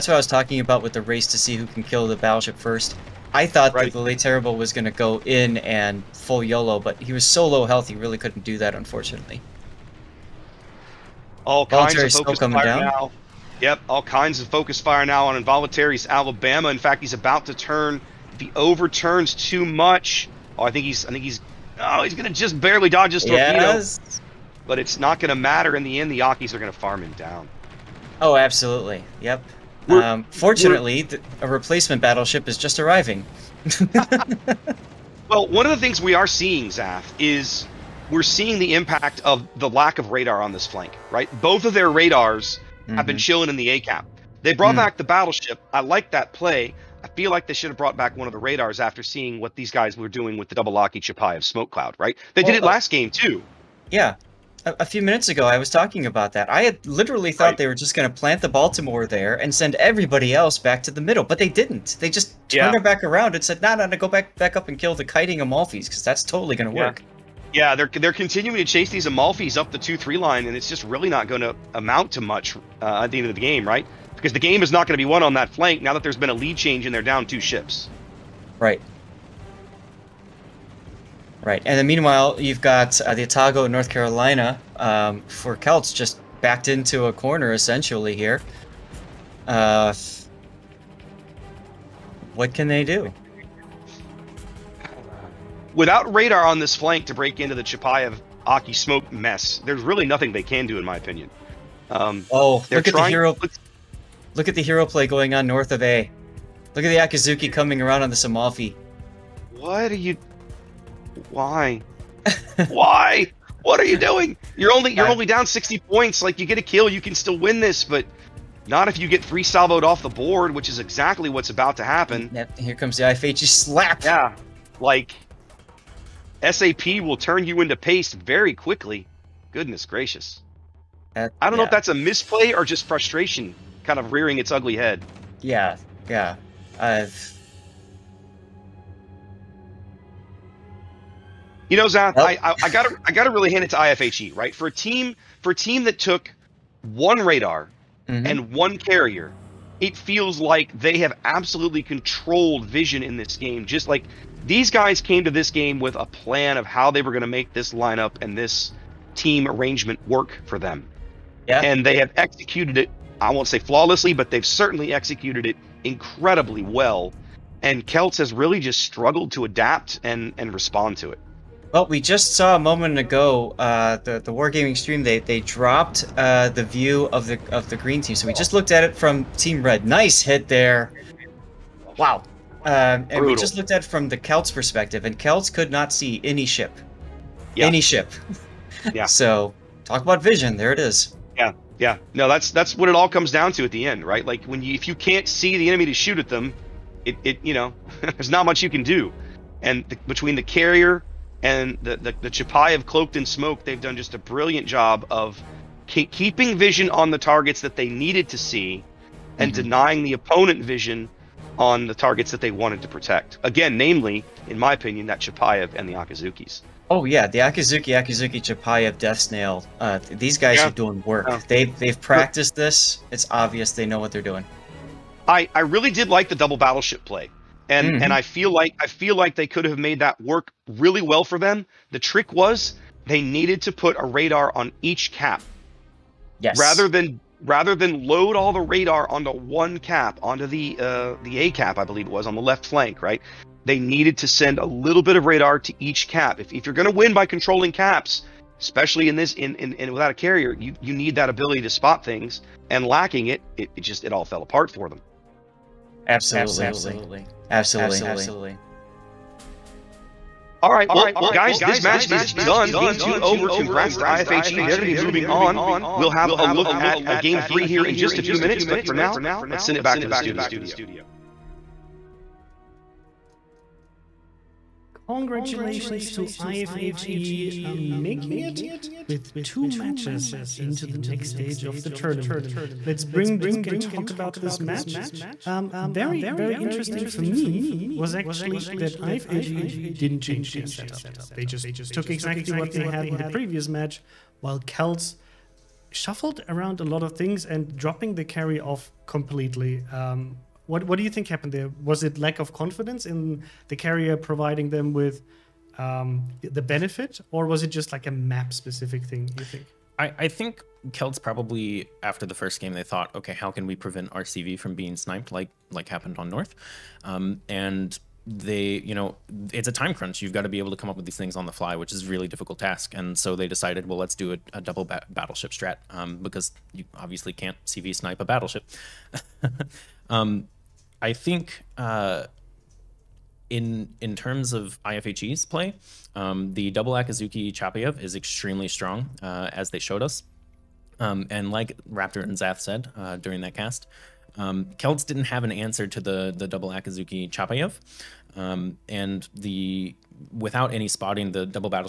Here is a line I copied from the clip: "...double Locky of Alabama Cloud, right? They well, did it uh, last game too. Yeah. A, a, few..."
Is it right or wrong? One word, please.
wrong.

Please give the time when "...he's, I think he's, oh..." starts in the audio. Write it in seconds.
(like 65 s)
20 s.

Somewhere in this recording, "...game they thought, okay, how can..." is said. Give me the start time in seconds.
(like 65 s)
312 s.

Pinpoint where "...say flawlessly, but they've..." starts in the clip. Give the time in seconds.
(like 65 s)
163 s.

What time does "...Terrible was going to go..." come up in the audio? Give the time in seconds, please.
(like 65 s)
4 s.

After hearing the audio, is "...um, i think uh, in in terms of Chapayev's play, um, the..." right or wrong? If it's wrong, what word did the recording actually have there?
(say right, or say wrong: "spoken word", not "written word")
wrong: "IFHE", not "Chapayev".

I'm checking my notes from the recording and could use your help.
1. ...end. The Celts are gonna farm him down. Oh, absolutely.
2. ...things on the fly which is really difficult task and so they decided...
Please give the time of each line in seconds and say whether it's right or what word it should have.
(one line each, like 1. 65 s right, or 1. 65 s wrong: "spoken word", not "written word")
1. 25 s wrong: "Akis", not "Celts"
2. 321 s right.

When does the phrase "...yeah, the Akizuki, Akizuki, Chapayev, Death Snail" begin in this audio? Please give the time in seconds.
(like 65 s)
217 s.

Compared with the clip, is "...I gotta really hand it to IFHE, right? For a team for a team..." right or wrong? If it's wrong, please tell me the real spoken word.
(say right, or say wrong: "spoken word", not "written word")
right.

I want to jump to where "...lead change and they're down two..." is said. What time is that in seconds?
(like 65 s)
76 s.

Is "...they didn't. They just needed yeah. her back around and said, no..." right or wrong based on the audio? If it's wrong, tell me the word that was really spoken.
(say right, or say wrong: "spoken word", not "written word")
wrong: "turned", not "needed".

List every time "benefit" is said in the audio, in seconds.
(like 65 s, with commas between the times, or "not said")
306 s.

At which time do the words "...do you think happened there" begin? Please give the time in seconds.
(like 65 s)
300 s.